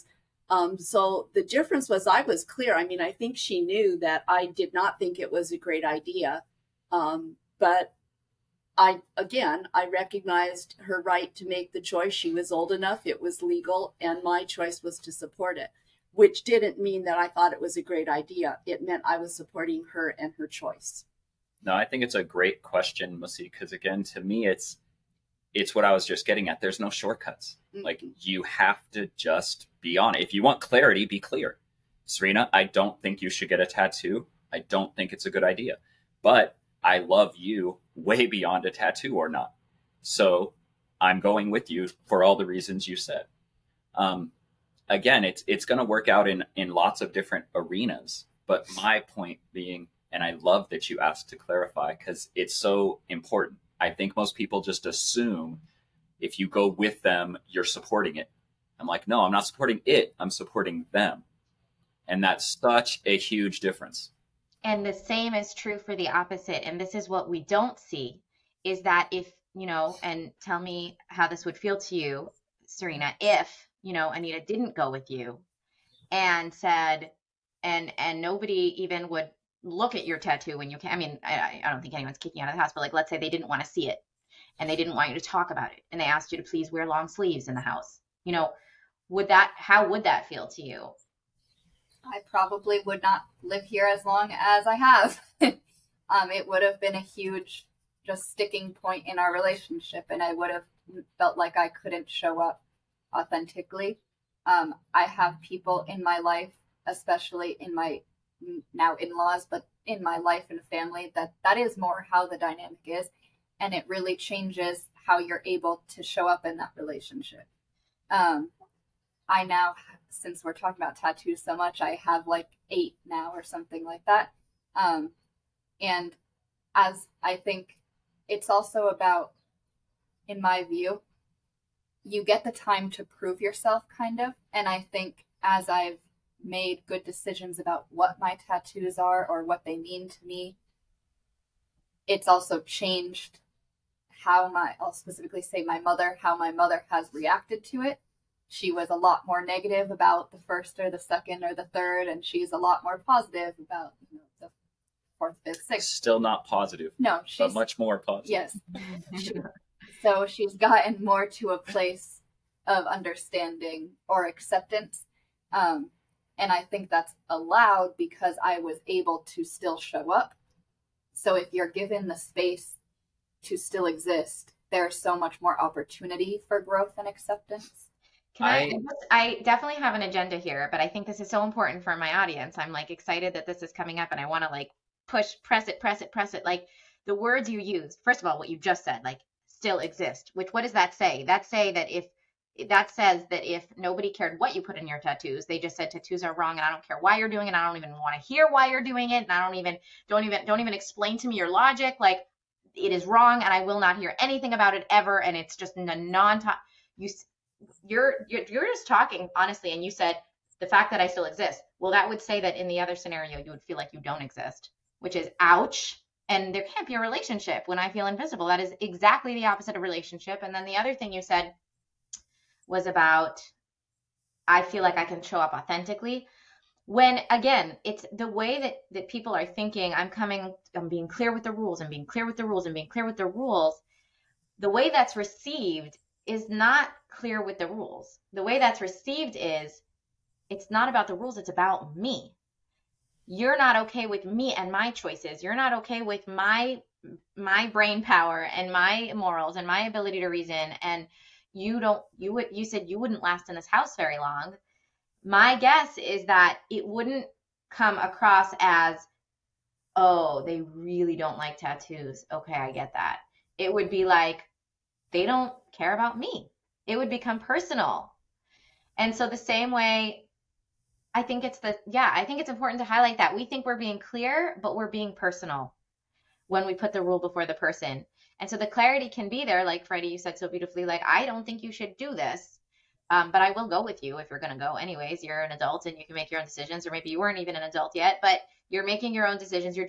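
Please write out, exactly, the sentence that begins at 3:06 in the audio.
Like the words you use, first of all, what you just said, like still exist, which what does that say?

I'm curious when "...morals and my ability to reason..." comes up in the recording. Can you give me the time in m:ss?
4:09.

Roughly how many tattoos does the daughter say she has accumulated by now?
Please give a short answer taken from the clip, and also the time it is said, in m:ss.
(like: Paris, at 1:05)
8, at 2:02.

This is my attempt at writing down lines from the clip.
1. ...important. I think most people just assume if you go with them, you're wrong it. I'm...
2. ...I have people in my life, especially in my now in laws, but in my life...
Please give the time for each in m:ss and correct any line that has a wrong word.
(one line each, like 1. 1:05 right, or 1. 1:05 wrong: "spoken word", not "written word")
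1. 0:53 wrong: "supporting", not "wrong"
2. 1:44 right.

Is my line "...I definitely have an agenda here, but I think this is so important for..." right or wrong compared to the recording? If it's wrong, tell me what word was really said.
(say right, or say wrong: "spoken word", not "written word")
right.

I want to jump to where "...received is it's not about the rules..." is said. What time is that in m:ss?
3:58.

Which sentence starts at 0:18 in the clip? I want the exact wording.
It meant I was supporting her and her choice.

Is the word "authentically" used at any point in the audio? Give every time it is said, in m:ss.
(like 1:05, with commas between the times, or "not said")
1:43, 3:45.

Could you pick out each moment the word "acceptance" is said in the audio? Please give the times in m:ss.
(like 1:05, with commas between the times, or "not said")
2:44, 2:57.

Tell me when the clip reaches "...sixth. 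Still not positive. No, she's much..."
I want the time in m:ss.
2:35.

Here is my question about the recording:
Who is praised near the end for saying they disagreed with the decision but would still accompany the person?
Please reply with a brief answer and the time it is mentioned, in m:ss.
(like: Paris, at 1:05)
Freddy, at 4:39.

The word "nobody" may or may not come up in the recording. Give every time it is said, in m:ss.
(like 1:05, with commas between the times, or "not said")
1:18, 3:13.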